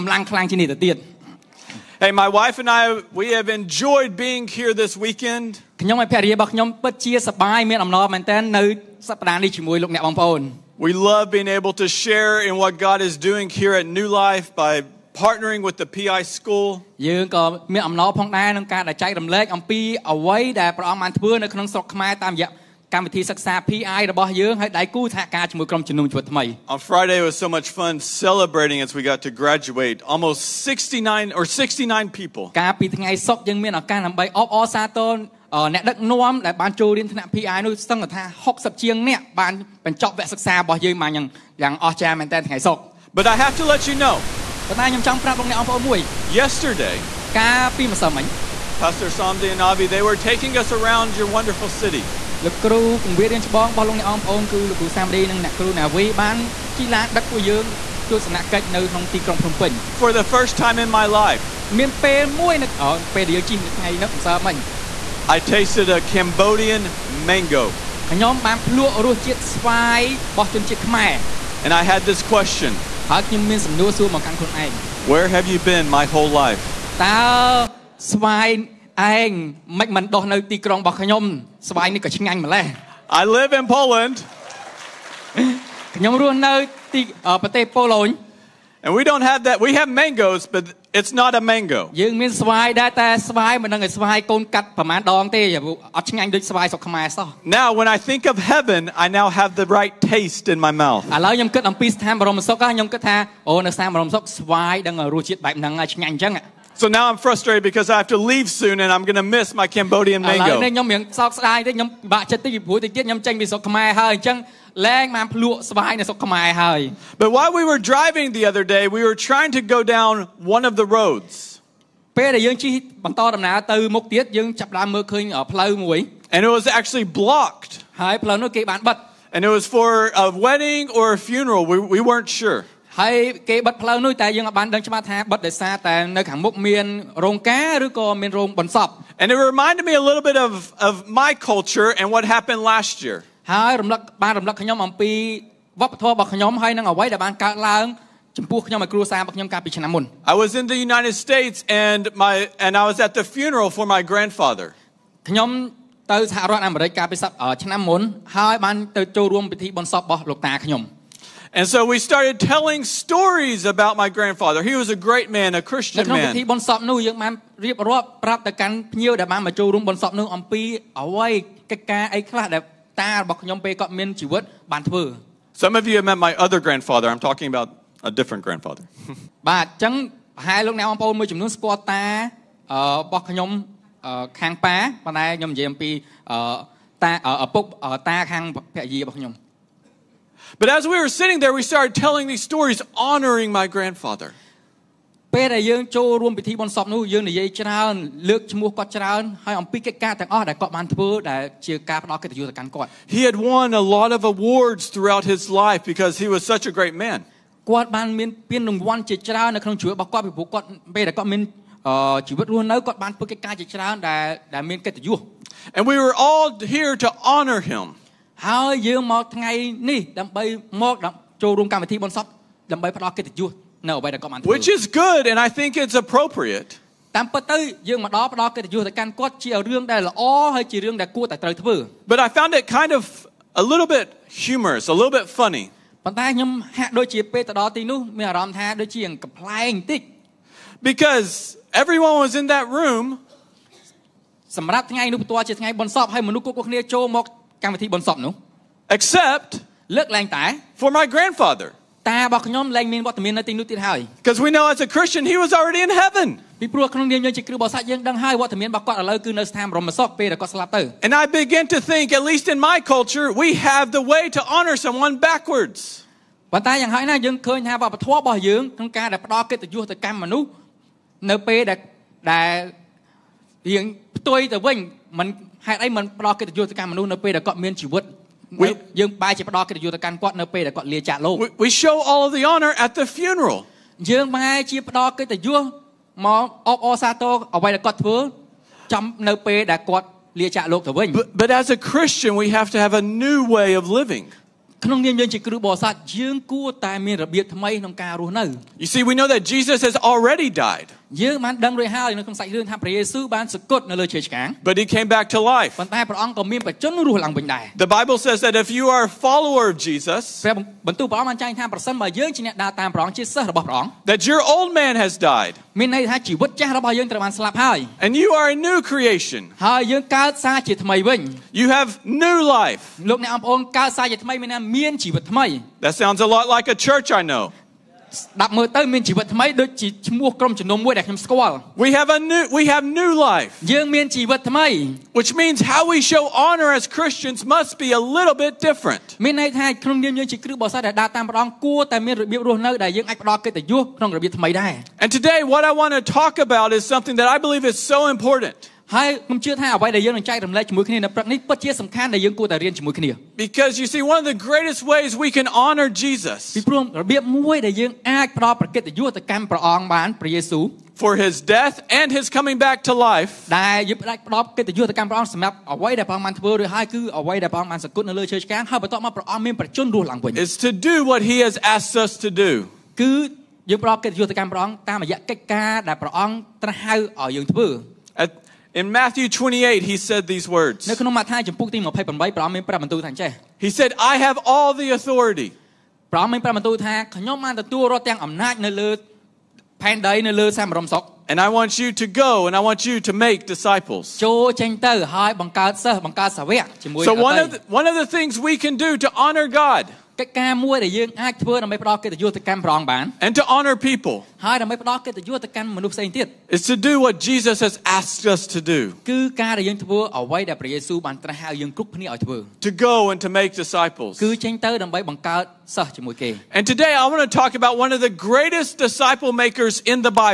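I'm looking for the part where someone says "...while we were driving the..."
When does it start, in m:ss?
1:57.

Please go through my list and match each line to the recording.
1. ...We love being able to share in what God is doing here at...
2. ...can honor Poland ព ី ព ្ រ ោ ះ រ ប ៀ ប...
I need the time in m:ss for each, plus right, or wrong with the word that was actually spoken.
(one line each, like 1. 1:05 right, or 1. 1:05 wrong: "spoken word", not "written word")
1. 0:05 right
2. 5:55 wrong: "Jesus", not "Poland".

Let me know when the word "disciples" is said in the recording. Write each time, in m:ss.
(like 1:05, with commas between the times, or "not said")
6:33, 6:53, 6:58.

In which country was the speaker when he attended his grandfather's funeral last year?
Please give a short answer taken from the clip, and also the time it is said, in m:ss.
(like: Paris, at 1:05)
United States, at 2:30.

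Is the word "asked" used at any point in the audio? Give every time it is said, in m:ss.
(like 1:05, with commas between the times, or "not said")
6:11, 6:47.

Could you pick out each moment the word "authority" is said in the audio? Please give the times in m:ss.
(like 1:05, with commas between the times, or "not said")
6:24.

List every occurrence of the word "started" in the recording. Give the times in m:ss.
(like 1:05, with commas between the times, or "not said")
2:42, 3:11.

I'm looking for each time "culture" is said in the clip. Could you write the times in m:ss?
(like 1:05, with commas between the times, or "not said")
2:21, 4:22.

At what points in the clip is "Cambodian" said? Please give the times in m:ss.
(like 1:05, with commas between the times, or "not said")
1:06, 1:49.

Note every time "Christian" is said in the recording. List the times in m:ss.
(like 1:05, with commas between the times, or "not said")
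2:45, 4:14, 4:51, 5:36.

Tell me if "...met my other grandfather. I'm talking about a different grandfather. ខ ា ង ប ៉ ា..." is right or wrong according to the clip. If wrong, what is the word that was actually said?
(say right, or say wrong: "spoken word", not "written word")
right.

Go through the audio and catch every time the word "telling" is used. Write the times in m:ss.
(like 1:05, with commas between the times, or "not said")
2:42, 3:11.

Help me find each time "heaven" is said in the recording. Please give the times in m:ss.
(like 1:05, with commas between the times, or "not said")
1:38, 4:16.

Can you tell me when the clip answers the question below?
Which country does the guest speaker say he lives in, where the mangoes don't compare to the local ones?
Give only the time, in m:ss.
1:23.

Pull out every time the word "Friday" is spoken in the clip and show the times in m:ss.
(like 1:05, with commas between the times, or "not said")
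0:26.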